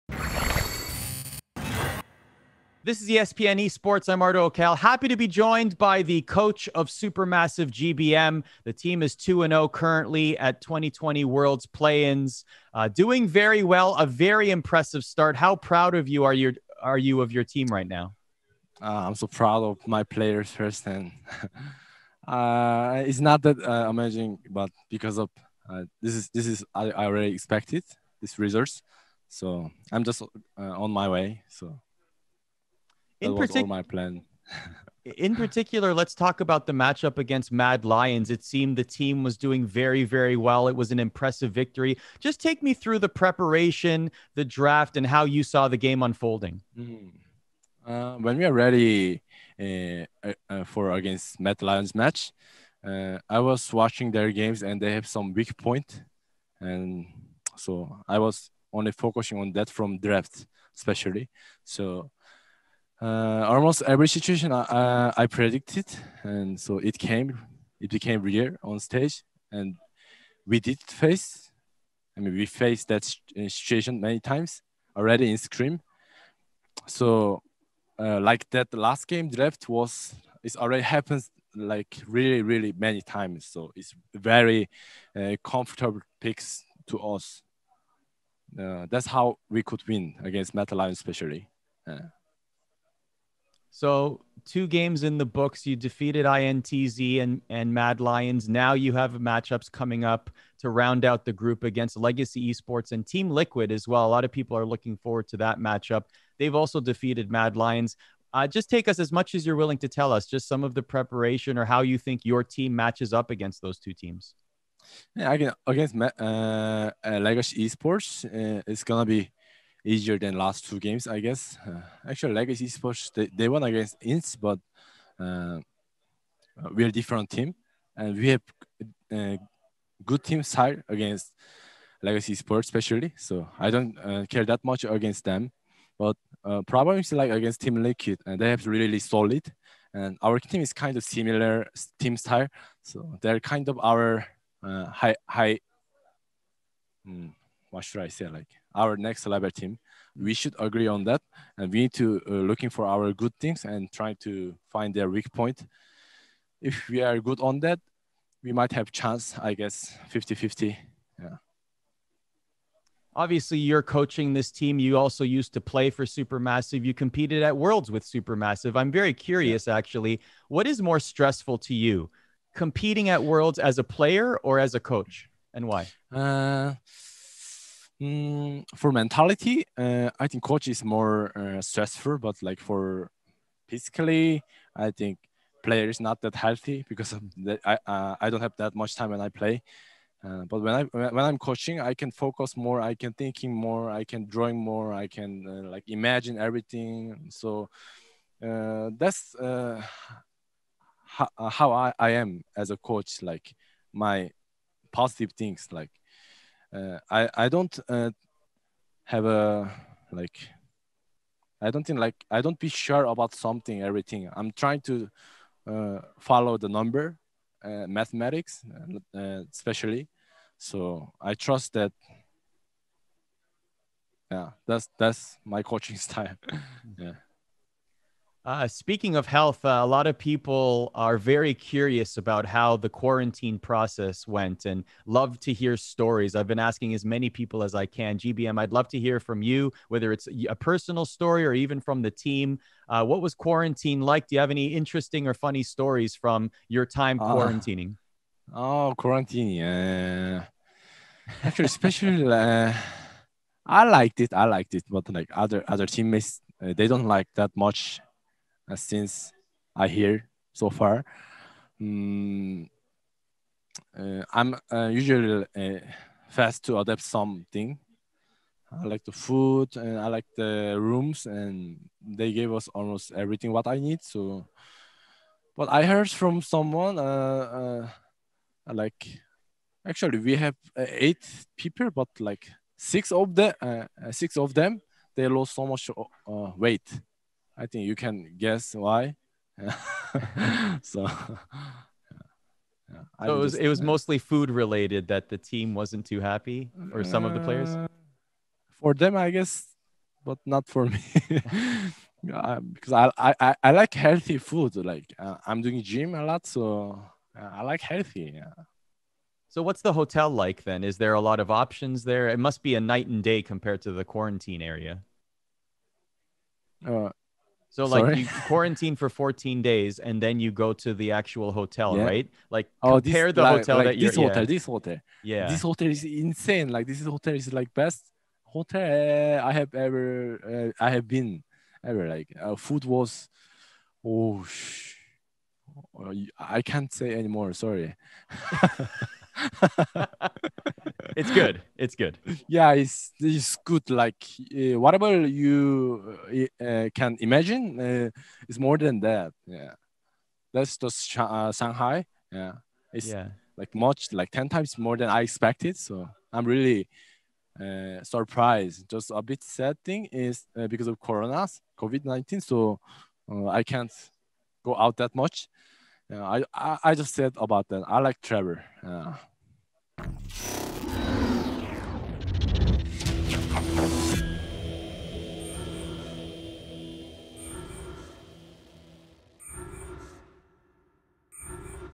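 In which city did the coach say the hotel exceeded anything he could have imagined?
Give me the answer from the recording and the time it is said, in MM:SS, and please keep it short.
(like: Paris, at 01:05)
Shanghai, at 05:51.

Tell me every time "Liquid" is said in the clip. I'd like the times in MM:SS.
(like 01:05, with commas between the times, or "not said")
01:43, 02:17.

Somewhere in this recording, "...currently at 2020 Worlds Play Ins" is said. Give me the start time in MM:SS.
00:09.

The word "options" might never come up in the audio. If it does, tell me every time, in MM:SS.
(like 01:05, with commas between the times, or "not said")
05:11.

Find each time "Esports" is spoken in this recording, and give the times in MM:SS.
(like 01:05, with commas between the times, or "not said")
00:03, 01:42, 01:57.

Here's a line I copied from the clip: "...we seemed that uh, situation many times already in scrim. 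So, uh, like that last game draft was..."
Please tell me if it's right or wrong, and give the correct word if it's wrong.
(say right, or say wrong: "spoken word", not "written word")
wrong: "faced", not "seemed".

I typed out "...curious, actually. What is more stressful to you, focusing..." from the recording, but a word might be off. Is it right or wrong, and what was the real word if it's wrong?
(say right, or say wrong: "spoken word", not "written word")
wrong: "competing", not "focusing".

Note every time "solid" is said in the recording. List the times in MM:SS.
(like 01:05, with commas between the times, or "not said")
02:18.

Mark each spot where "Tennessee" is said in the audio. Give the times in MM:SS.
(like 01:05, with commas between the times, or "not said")
not said.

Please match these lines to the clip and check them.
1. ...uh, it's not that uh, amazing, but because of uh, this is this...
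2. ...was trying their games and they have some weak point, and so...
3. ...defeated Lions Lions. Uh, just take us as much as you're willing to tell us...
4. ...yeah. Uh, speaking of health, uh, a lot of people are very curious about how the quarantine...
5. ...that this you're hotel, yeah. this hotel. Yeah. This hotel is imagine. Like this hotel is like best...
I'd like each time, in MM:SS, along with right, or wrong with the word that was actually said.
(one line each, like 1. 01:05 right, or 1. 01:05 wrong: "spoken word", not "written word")
1. 00:22 right
2. 00:53 wrong: "watching", not "trying"
3. 01:46 wrong: "Mad", not "Lions"
4. 03:46 right
5. 05:23 wrong: "insane", not "imagine".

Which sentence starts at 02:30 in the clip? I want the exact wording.
we should agree on that, and we need to uh, looking for our good things and trying to find their weak point.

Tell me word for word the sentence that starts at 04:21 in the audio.
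Mm, uh, I'm uh, usually uh, fast to adapt something.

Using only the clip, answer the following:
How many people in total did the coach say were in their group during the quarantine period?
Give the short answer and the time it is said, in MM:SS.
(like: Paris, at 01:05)
8, at 04:40.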